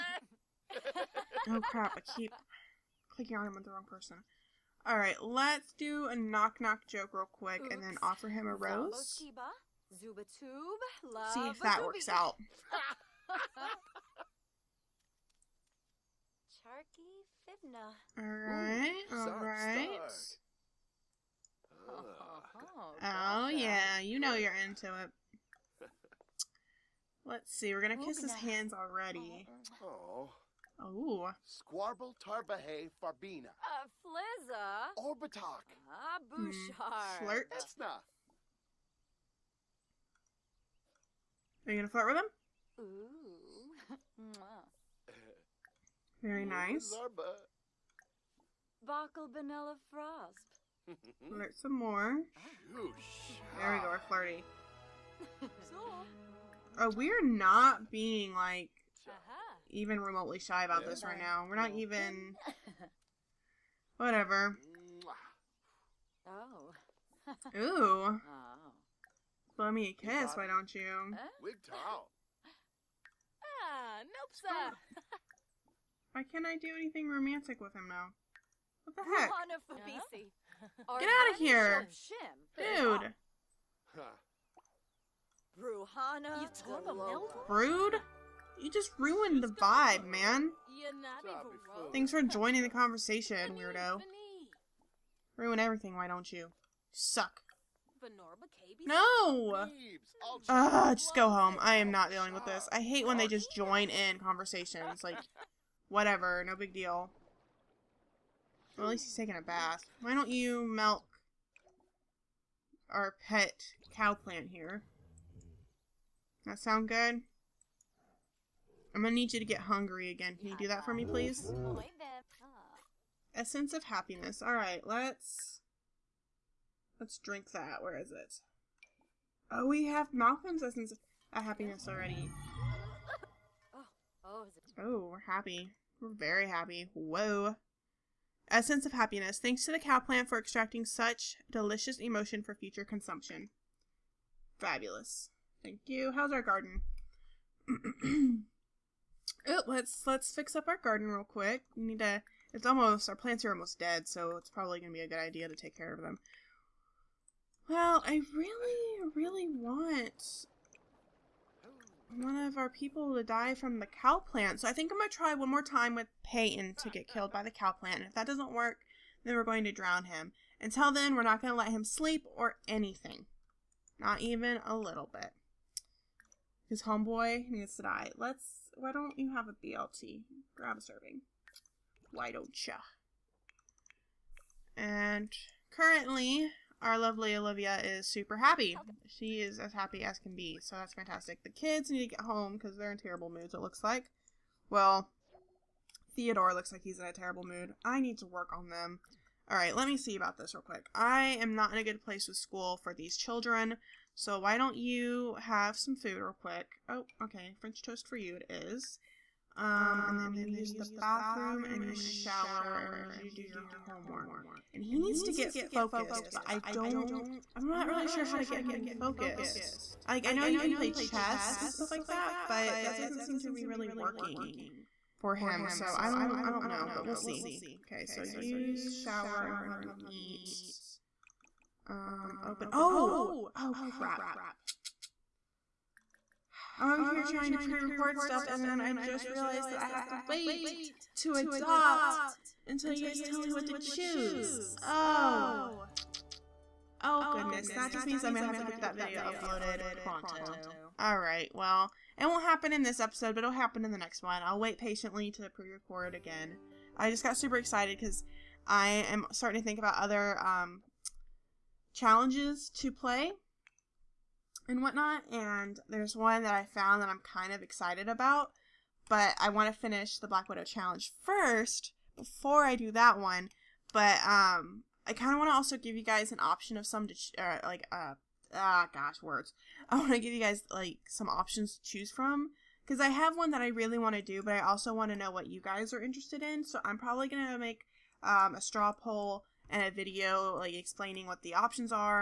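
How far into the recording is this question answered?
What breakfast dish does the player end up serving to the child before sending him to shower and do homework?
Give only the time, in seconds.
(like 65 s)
207 s.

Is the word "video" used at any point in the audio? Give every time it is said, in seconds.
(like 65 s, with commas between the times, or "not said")
248 s, 289 s.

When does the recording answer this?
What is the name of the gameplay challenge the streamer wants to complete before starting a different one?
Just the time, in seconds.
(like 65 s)
270 s.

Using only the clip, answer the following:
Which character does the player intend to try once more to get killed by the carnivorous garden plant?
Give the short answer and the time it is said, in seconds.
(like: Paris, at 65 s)
Peyton, at 166 s.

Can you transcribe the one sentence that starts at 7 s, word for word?
and then offer him a rose.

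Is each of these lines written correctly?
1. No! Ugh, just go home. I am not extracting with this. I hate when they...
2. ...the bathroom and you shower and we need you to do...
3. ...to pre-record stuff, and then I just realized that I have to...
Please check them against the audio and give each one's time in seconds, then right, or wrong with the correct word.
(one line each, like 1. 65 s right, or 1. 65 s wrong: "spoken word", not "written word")
1. 98 s wrong: "dealing", not "extracting"
2. 210 s right
3. 237 s right.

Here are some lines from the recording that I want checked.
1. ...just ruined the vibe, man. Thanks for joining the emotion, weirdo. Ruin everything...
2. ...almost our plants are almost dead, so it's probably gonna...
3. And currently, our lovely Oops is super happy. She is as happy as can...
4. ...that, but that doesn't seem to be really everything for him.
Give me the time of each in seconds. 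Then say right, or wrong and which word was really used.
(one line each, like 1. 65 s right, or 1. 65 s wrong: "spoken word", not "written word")
1. 88 s wrong: "conversation", not "emotion"
2. 152 s right
3. 184 s wrong: "Olivia", not "Oops"
4. 222 s wrong: "working", not "everything".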